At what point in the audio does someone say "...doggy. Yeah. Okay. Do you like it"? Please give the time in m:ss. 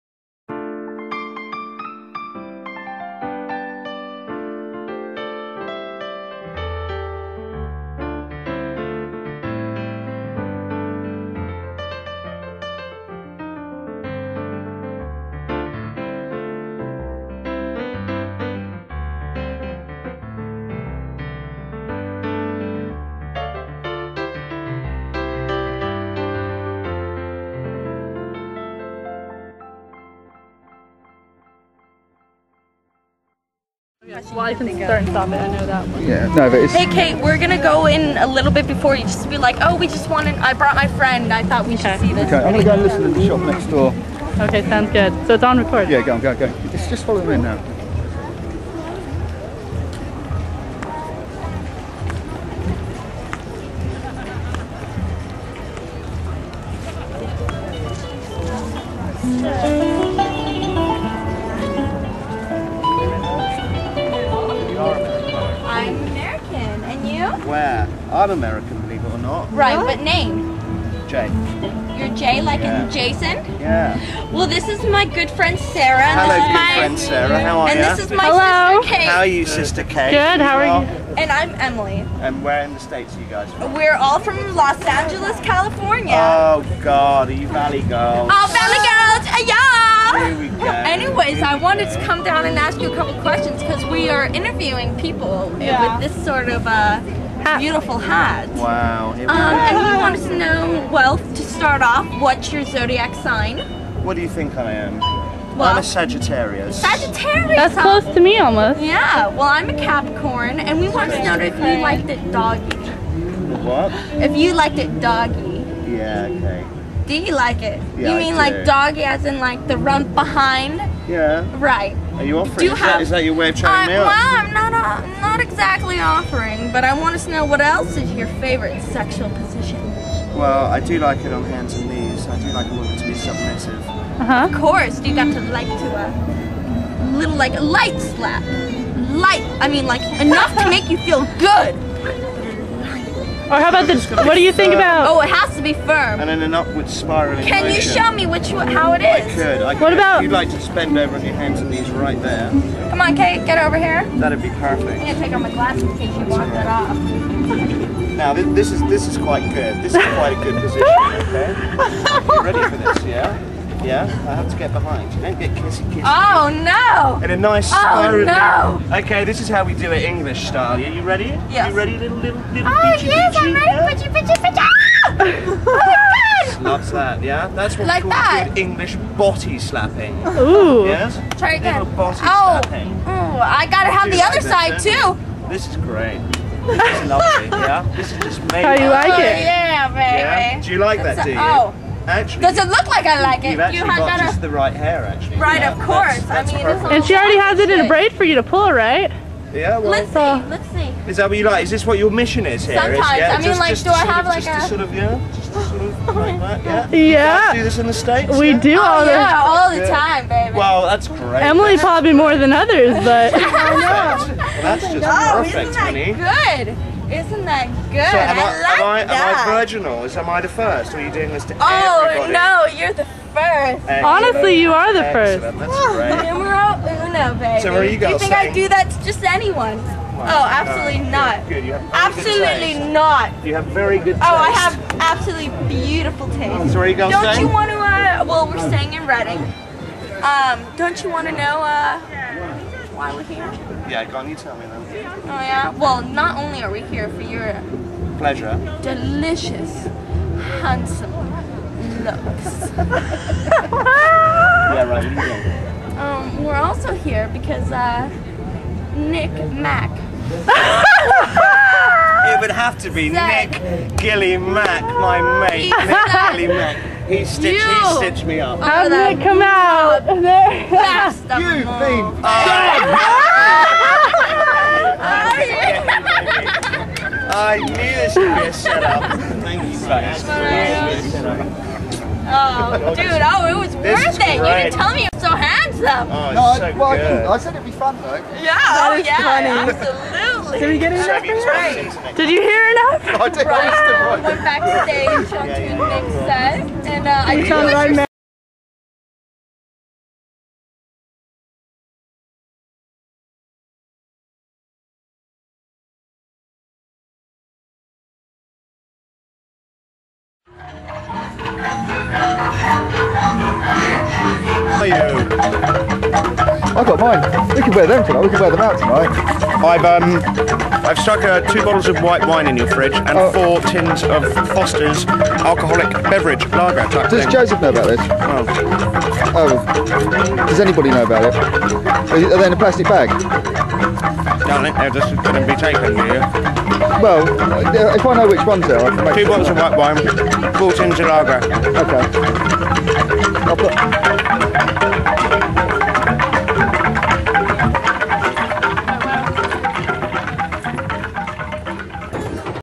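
1:55.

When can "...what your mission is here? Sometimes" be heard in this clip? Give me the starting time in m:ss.
3:21.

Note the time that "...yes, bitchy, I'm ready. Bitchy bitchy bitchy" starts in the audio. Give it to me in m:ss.
2:53.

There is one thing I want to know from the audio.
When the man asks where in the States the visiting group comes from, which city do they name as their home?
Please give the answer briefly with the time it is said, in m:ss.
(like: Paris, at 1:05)
Los Angeles, at 1:24.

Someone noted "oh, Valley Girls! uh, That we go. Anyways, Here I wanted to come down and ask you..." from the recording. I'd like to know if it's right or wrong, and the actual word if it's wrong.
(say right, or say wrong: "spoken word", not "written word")
wrong: "Here", not "That".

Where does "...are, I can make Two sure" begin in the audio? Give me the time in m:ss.
5:38.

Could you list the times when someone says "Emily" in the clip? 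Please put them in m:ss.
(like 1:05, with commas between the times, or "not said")
1:21, 3:31.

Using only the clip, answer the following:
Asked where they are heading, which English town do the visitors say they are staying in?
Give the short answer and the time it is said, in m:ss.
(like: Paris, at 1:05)
Reading, at 3:59.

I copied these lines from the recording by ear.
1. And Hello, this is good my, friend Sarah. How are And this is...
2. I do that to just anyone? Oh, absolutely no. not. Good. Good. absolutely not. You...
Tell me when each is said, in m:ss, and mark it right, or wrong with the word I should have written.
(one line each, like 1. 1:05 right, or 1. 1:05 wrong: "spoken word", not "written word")
1. 1:16 right
2. 3:48 right.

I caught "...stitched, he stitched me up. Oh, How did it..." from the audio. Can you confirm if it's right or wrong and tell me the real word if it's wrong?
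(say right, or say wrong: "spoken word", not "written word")
right.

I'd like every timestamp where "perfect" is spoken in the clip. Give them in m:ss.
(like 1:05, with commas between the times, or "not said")
2:34, 3:35.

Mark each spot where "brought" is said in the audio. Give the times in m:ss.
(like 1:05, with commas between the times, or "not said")
0:40.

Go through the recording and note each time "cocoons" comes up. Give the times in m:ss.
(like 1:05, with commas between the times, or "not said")
not said.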